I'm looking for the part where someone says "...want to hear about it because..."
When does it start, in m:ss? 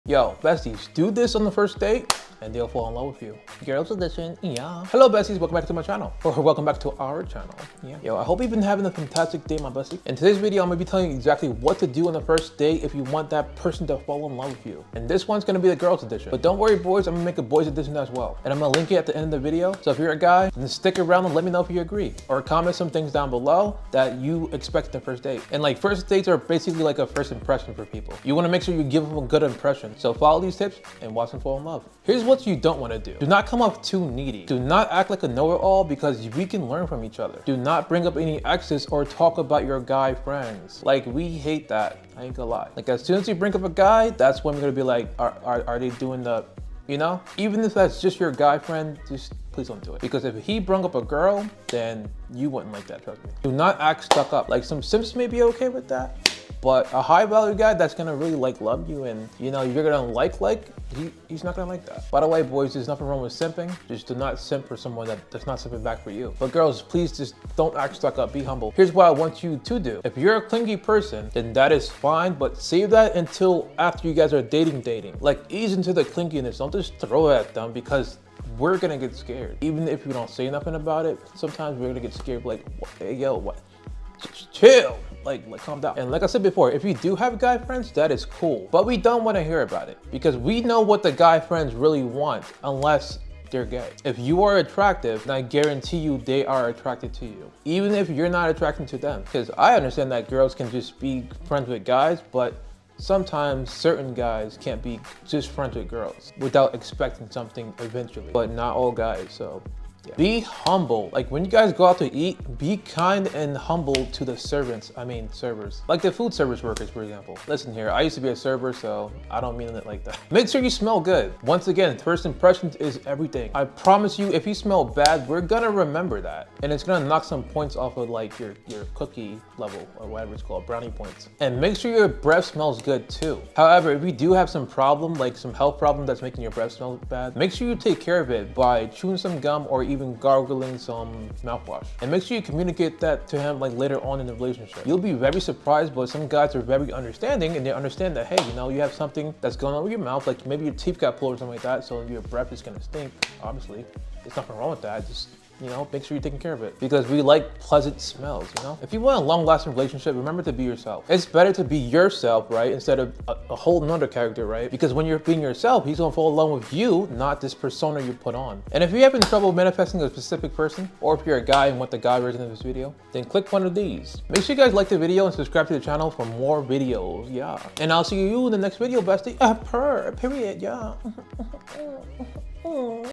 1:29.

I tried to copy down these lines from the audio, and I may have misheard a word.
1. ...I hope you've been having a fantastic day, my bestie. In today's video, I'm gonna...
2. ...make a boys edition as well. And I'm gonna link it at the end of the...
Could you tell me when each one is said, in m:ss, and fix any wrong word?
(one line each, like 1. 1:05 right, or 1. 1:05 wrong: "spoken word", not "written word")
1. 0:08 right
2. 0:17 right.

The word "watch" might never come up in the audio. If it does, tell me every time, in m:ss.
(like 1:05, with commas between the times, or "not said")
0:31.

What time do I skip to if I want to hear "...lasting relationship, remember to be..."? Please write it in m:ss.
2:39.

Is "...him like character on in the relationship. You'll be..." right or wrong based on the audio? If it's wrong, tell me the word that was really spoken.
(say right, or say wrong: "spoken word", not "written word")
wrong: "later", not "character".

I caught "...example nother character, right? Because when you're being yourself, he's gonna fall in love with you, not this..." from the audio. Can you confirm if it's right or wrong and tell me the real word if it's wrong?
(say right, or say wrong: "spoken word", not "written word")
wrong: "whole", not "example".